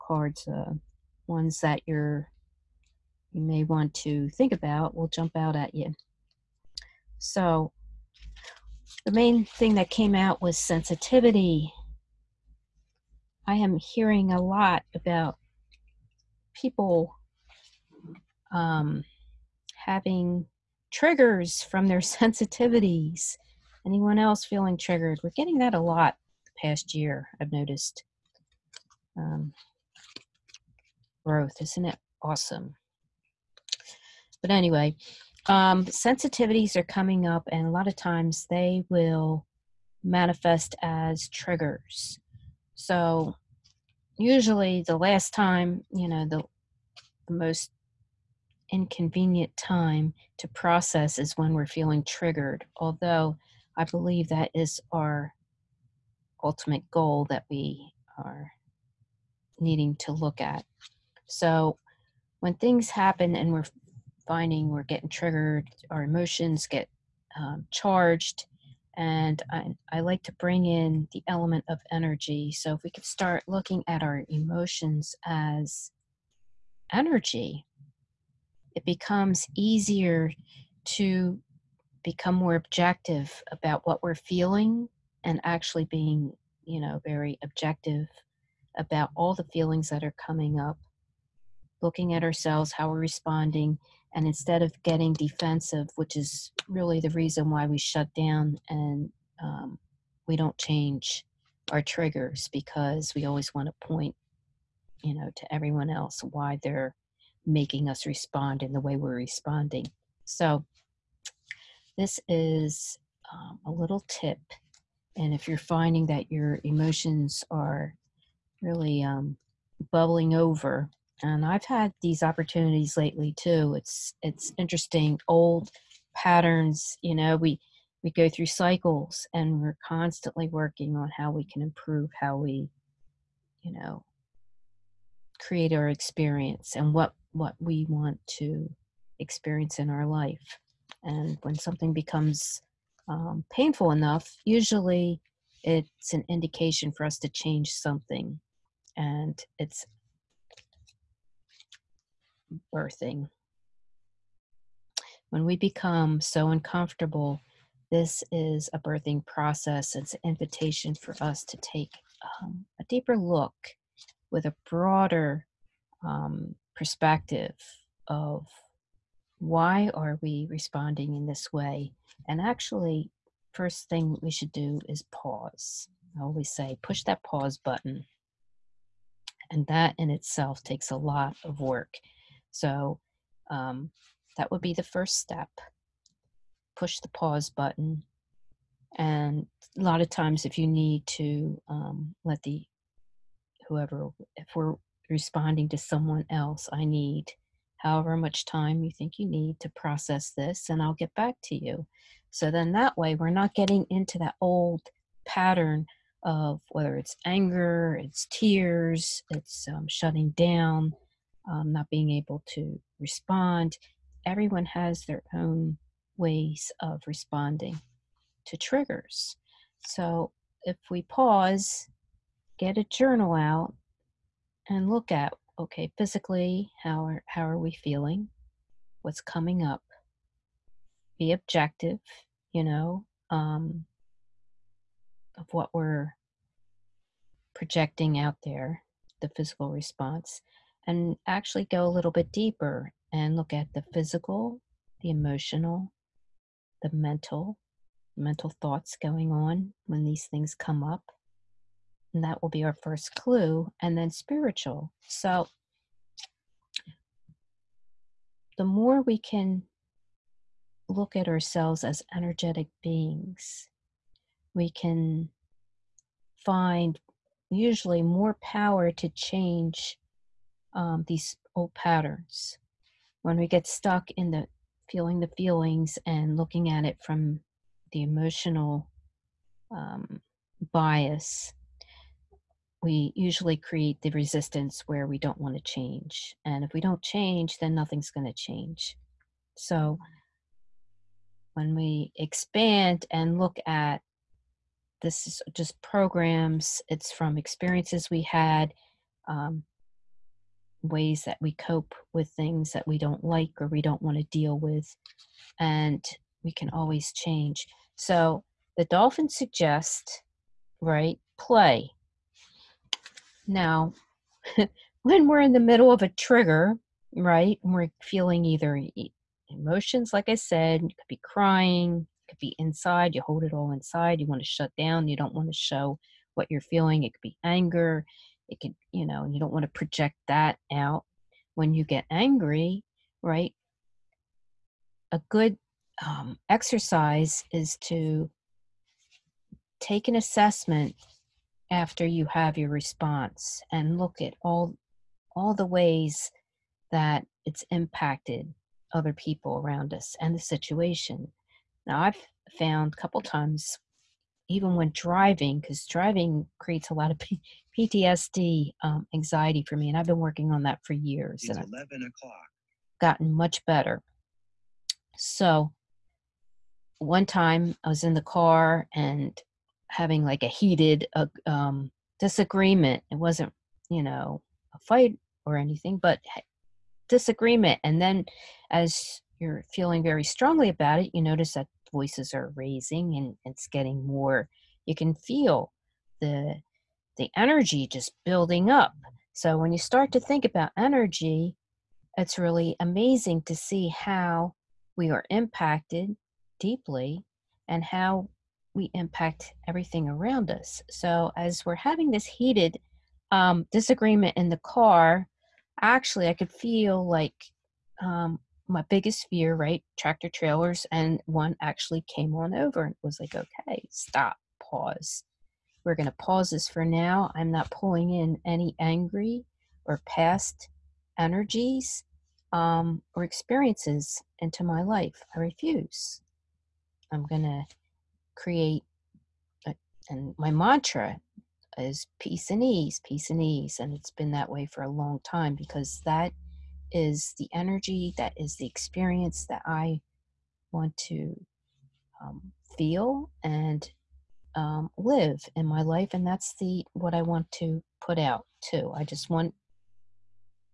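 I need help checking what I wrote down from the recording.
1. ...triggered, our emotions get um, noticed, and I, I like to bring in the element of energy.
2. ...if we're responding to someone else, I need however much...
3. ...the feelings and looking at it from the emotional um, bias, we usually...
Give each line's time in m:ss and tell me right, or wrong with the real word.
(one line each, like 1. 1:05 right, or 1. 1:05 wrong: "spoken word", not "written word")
1. 1:05 wrong: "charged", not "noticed"
2. 3:14 right
3. 4:35 right.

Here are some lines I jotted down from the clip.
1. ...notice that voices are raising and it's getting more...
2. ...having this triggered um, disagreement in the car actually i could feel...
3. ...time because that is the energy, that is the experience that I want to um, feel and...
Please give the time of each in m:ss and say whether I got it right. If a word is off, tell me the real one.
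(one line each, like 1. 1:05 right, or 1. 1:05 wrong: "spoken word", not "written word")
1. 6:21 right
2. 6:41 wrong: "heated", not "triggered"
3. 7:15 right.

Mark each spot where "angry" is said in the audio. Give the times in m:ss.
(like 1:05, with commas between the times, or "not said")
5:32, 6:58.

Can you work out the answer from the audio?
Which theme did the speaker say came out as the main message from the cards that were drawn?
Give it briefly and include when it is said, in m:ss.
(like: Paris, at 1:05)
Sensitivity, at 0:10.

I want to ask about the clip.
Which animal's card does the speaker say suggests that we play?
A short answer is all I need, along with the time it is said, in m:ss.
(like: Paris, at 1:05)
Dolphin, at 5:08.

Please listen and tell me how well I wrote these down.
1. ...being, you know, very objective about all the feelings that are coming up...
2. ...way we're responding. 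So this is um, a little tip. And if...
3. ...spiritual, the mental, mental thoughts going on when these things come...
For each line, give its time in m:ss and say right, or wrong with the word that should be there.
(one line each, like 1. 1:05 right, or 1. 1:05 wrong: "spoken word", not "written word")
1. 1:25 right
2. 1:48 right
3. 4:05 wrong: "emotional", not "spiritual".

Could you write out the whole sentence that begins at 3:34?
Everyone has their own ways of responding to triggers.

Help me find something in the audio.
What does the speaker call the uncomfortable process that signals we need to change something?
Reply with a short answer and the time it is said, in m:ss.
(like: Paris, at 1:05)
Birthing process, at 2:38.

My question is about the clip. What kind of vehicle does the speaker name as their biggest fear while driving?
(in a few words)
Tractor trailers.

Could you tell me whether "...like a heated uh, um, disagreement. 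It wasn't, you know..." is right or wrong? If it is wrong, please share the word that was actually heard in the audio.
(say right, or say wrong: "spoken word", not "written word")
right.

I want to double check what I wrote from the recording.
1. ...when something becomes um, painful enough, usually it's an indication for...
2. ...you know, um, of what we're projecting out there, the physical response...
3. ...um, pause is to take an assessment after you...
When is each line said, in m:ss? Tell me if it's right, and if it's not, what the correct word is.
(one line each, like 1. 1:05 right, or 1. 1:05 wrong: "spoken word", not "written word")
1. 2:21 right
2. 3:52 right
3. 5:36 wrong: "exercise", not "pause".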